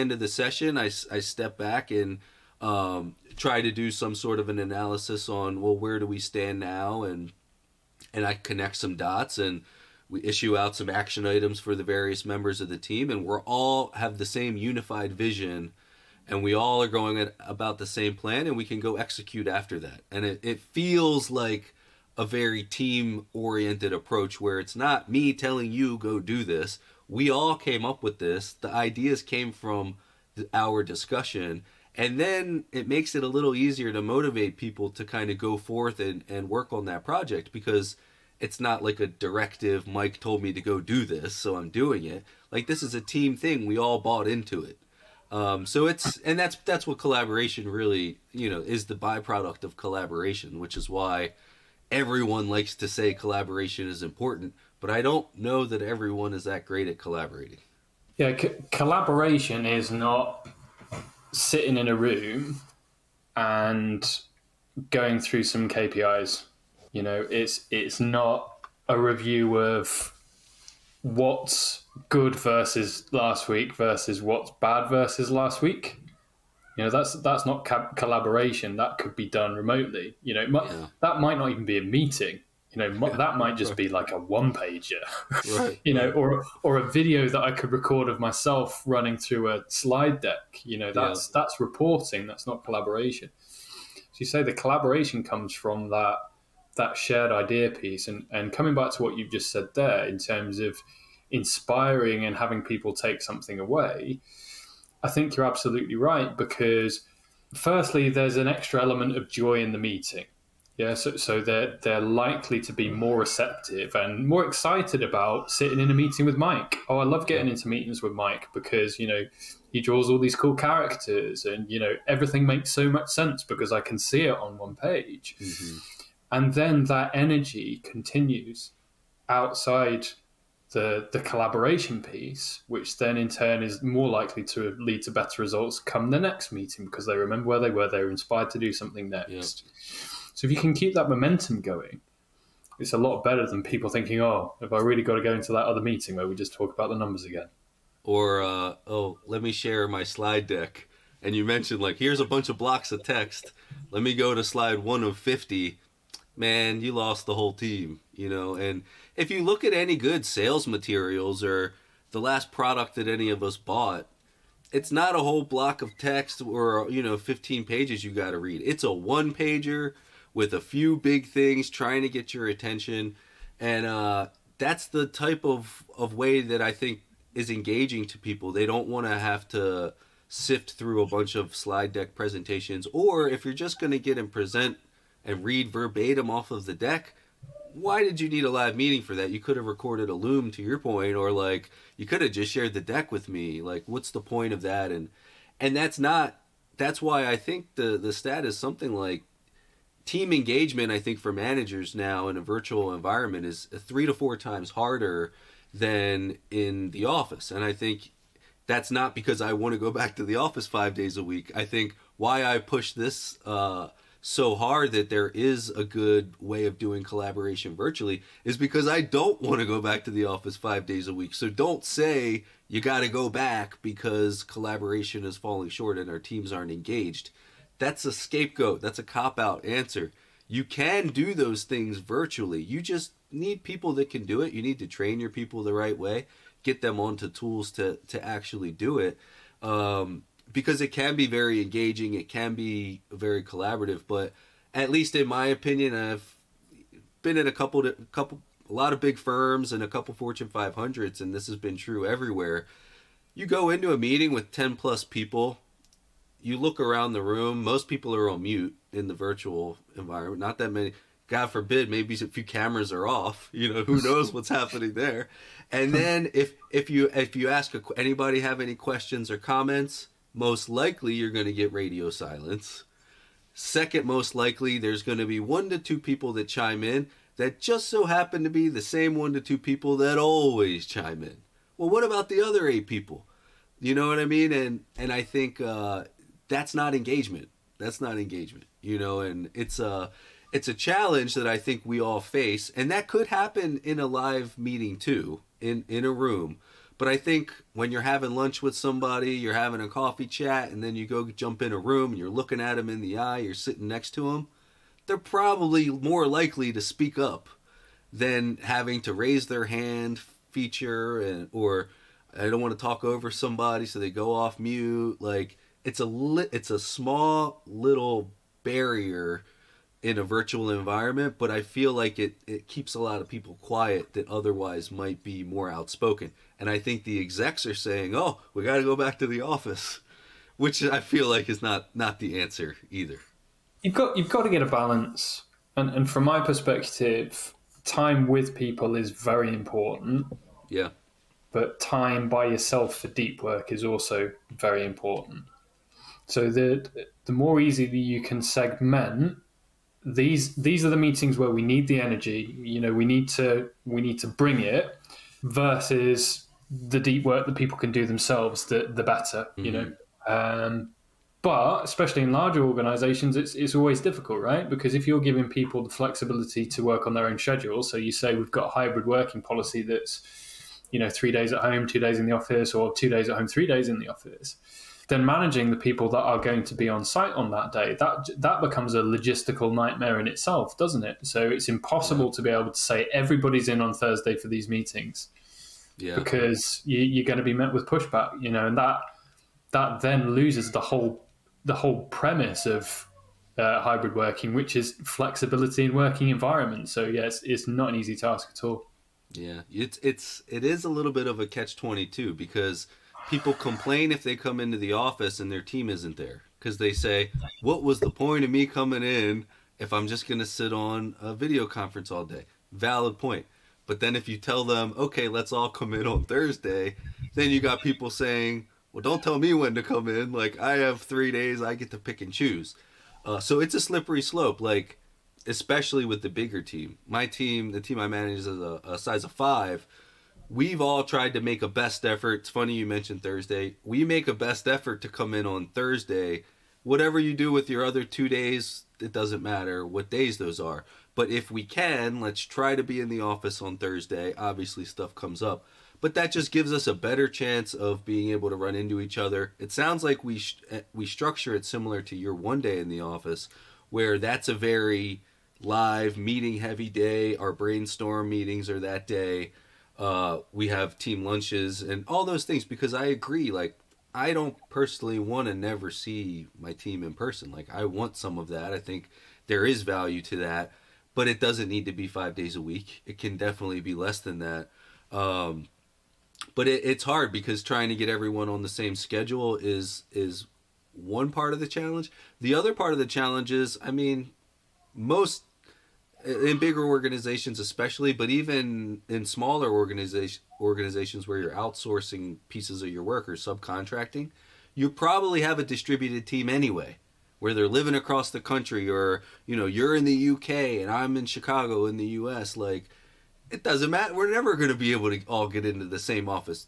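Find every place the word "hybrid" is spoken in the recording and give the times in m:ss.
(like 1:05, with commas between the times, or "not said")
6:08, 6:33.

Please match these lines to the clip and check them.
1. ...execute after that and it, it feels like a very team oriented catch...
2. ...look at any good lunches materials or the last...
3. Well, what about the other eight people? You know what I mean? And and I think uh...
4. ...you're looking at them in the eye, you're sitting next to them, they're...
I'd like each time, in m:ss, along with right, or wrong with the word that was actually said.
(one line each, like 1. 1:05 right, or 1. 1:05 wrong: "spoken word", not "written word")
1. 0:18 wrong: "approach", not "catch"
2. 2:39 wrong: "sales", not "lunches"
3. 4:41 right
4. 5:02 right.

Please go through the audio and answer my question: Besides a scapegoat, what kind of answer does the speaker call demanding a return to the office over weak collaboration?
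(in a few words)
Cop out.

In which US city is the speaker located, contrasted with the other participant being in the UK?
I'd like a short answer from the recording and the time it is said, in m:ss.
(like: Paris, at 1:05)
Chicago, at 8:21.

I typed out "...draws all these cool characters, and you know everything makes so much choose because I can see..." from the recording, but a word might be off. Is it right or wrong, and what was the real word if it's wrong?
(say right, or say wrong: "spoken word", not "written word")
wrong: "sense", not "choose".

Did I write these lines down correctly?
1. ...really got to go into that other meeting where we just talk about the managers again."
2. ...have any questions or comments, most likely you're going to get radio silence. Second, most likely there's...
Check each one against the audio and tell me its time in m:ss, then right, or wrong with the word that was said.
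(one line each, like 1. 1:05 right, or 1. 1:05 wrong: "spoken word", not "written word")
1. 2:24 wrong: "numbers", not "managers"
2. 4:28 right.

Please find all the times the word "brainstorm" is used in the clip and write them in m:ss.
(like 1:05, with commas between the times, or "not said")
7:37.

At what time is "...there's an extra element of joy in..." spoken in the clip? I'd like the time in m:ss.
1:48.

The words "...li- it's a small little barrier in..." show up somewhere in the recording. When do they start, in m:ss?
5:16.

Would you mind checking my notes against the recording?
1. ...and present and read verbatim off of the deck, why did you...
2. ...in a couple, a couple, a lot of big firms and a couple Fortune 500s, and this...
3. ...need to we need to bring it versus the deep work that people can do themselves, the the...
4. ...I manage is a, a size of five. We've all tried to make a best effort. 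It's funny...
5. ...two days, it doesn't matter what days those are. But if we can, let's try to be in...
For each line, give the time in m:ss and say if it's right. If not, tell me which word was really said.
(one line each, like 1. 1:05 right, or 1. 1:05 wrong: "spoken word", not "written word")
1. 3:04 right
2. 4:07 right
3. 5:53 right
4. 7:07 right
5. 7:18 right.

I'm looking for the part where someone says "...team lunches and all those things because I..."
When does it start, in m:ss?
7:40.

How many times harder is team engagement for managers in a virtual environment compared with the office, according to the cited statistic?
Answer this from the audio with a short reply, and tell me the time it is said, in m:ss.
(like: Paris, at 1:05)
3 to 4, at 3:23.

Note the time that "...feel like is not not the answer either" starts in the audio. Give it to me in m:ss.
5:30.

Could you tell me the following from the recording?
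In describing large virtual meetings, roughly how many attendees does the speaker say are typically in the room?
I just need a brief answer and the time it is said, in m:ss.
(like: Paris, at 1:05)
10 plus, at 4:14.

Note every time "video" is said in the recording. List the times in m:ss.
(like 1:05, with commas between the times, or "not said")
1:26, 6:51.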